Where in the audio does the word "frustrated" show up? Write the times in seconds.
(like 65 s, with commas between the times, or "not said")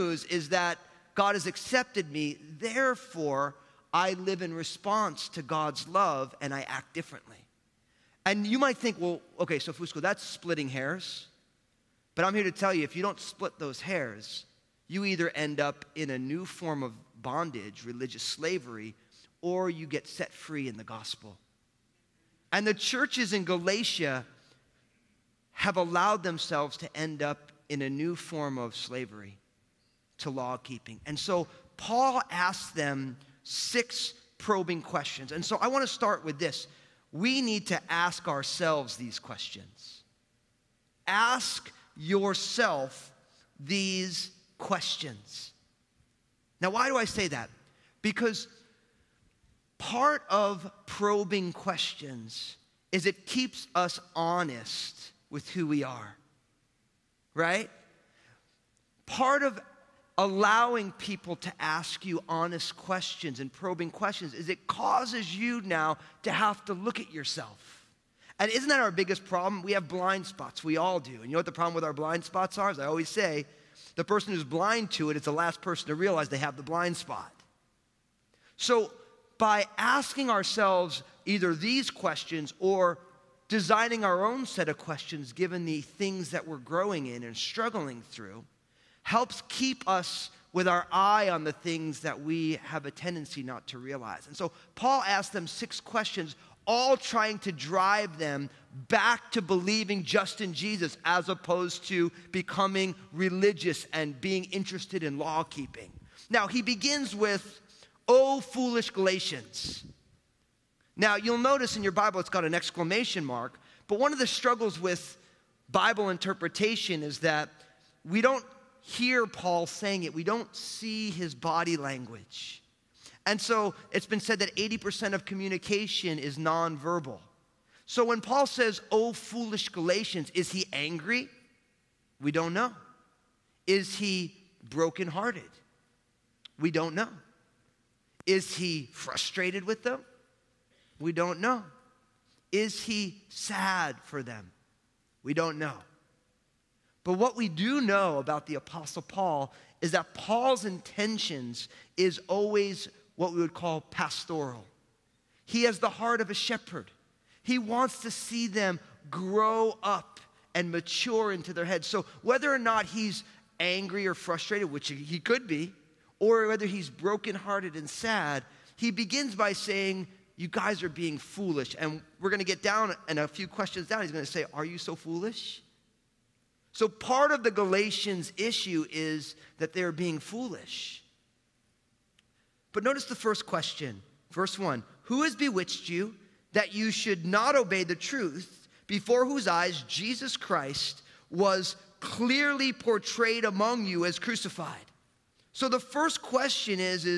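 138 s, 164 s.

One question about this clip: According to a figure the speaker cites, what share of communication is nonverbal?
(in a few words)
80%.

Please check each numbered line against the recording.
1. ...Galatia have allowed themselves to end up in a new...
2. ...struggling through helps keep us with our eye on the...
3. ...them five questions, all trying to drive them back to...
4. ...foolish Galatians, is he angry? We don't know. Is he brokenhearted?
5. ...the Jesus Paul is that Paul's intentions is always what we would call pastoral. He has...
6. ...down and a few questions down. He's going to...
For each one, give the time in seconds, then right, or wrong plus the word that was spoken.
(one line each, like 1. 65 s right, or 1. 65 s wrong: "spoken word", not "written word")
1. 23 s right
2. 87 s right
3. 95 s wrong: "six", not "five"
4. 129 s right
5. 148 s wrong: "Apostle", not "Jesus"
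6. 172 s right.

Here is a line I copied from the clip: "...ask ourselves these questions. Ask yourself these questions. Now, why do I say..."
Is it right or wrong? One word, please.
right.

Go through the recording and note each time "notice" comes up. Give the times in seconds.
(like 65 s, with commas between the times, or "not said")
111 s, 182 s.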